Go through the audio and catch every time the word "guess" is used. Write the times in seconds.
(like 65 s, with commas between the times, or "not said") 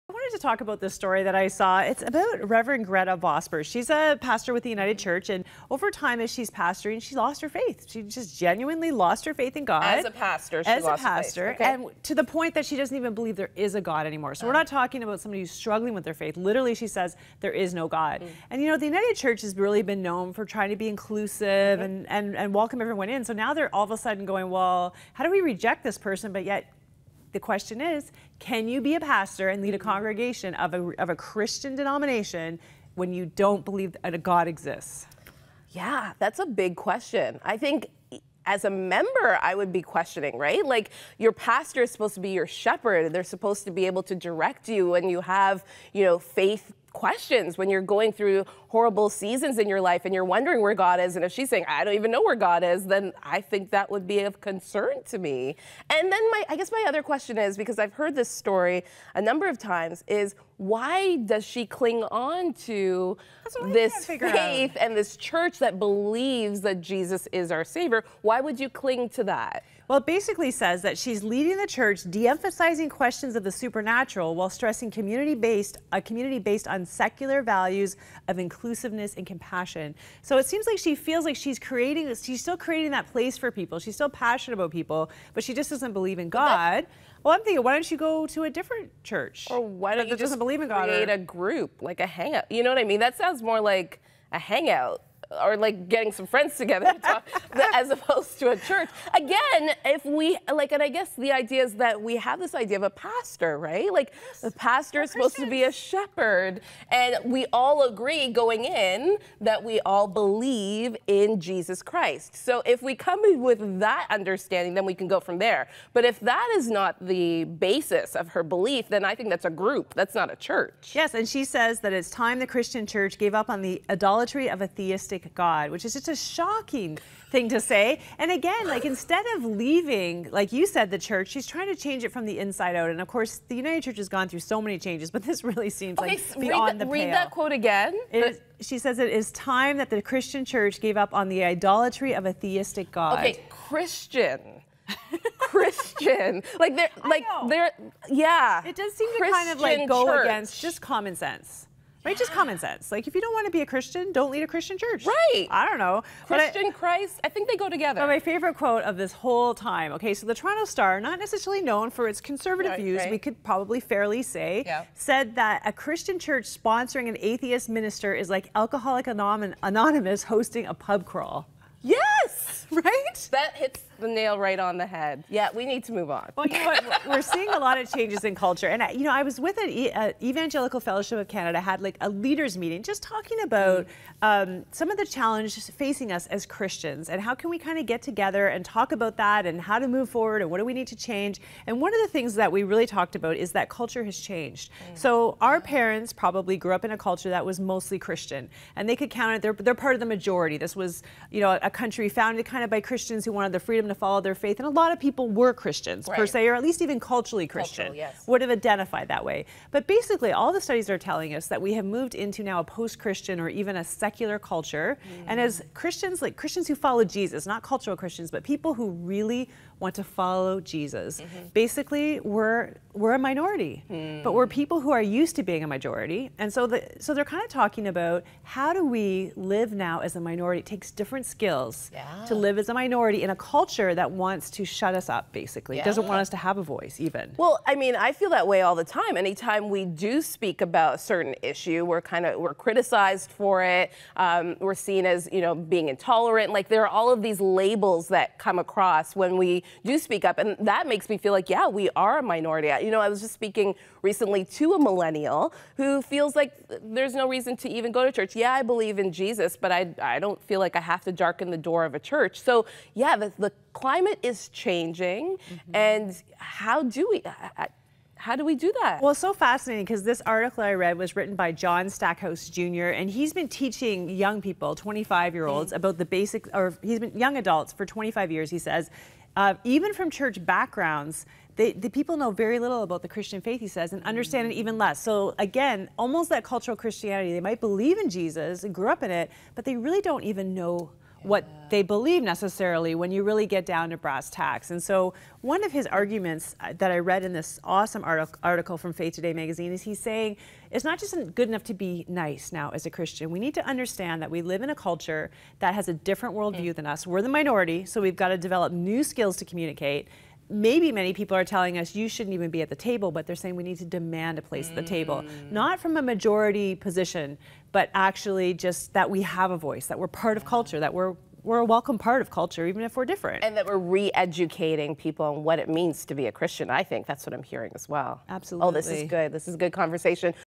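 56 s, 100 s.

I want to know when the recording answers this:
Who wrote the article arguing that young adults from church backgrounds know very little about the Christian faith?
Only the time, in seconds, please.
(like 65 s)
271 s.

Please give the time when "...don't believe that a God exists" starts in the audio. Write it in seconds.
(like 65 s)
33 s.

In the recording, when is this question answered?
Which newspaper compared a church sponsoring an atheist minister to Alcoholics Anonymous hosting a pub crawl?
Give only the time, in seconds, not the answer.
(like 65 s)
160 s.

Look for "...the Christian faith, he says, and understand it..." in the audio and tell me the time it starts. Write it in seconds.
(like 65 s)
283 s.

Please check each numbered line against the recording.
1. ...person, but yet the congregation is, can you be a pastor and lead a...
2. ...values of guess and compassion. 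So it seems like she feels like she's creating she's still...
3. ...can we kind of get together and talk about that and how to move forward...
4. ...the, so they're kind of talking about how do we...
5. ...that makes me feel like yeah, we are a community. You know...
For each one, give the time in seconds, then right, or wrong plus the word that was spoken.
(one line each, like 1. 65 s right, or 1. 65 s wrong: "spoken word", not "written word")
1. 26 s wrong: "question", not "congregation"
2. 77 s wrong: "inclusiveness", not "guess"
3. 187 s right
4. 226 s right
5. 250 s wrong: "minority", not "community".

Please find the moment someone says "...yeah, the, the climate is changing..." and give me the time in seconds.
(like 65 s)
262 s.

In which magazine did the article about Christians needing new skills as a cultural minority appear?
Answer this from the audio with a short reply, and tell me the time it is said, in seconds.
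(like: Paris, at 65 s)
Faith Today, at 298 s.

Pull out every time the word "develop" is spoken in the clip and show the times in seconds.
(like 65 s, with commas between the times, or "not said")
308 s.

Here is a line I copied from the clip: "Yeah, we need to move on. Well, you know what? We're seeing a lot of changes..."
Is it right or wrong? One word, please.
right.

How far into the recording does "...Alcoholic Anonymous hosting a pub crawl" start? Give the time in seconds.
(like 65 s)
168 s.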